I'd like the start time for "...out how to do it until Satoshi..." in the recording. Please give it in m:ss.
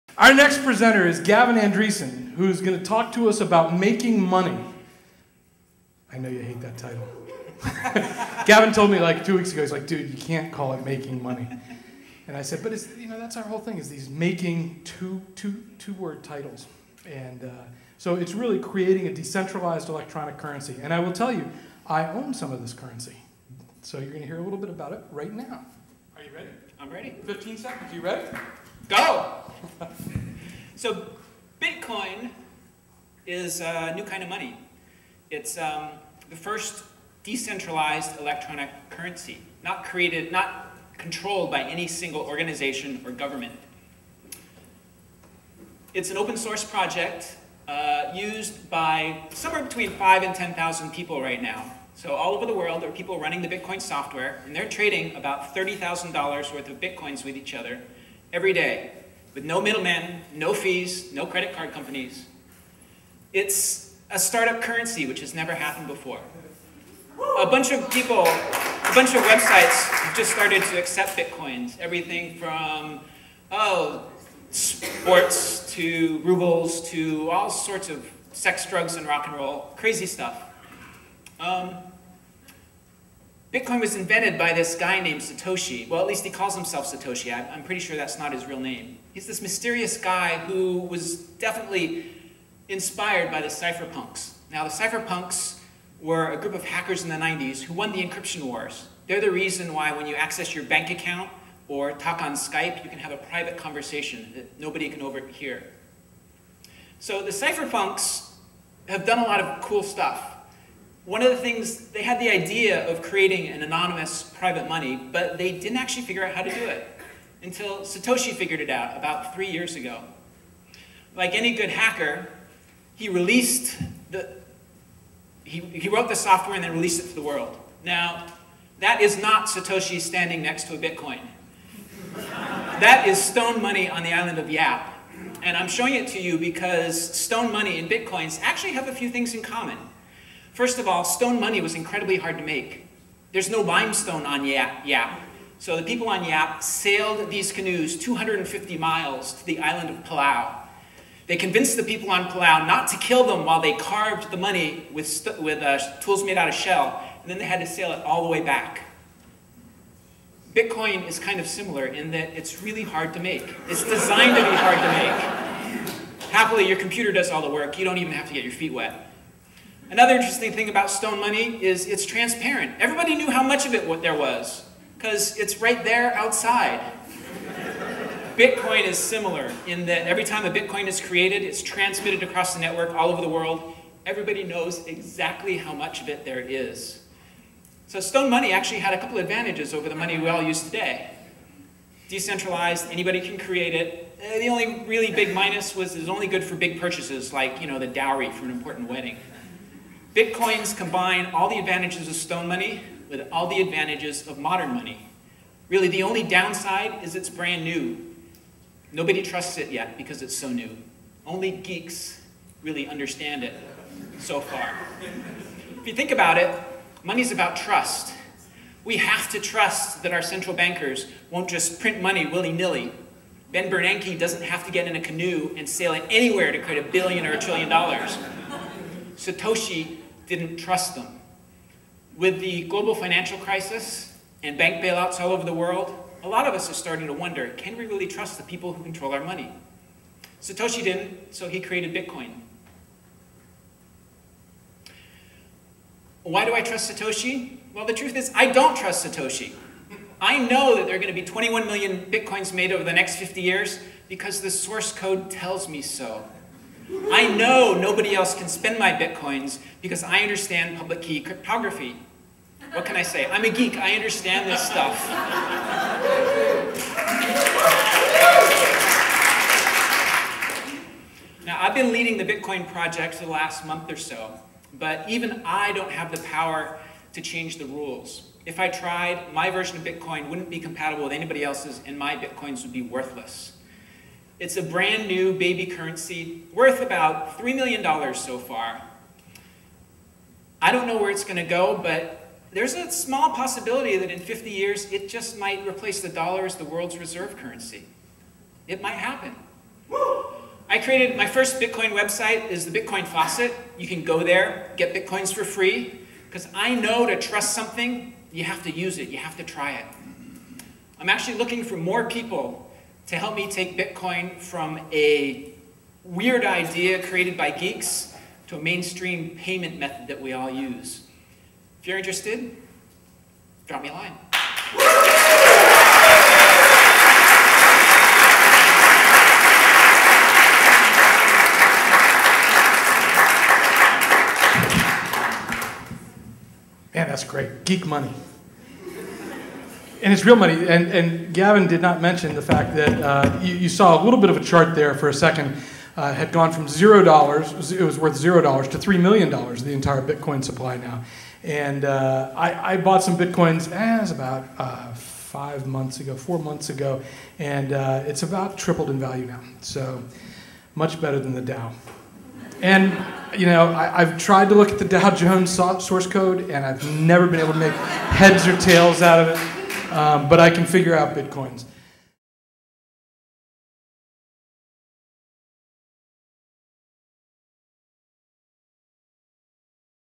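1:56.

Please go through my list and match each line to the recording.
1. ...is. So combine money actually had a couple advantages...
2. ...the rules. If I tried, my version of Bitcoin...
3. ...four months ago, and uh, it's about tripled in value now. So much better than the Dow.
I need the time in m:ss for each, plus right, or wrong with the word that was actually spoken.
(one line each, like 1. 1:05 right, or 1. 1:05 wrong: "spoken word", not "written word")
1. 3:06 wrong: "stone", not "combine"
2. 4:37 right
3. 5:56 right.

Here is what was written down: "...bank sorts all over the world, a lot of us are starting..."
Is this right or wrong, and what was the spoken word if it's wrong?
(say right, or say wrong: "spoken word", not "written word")
wrong: "bailouts", not "sorts".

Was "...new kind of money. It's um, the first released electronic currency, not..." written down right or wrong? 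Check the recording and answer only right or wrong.
wrong.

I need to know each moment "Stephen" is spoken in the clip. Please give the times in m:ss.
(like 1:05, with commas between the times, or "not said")
not said.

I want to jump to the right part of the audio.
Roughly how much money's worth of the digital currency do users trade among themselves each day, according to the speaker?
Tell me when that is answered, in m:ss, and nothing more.
0:55.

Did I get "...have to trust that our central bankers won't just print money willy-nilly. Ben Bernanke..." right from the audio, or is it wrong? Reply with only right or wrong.
right.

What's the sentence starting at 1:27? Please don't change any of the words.
I'm, pretty sure that's not his real name.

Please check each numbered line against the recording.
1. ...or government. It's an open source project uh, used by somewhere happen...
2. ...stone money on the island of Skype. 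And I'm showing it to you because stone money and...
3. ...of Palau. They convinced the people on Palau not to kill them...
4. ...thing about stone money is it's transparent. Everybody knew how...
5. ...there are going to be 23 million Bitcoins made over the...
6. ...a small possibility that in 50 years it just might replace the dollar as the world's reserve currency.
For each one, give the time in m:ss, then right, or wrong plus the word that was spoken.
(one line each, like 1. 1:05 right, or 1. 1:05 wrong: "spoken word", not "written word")
1. 0:43 wrong: "between", not "happen"
2. 2:13 wrong: "Yap", not "Skype"
3. 2:29 right
4. 2:50 right
5. 4:10 wrong: "21", not "23"
6. 4:52 right.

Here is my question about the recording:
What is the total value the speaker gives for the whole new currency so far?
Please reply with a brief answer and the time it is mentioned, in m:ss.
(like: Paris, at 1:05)
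$3 million, at 4:47.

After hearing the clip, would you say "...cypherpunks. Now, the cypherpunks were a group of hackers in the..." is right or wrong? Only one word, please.
right.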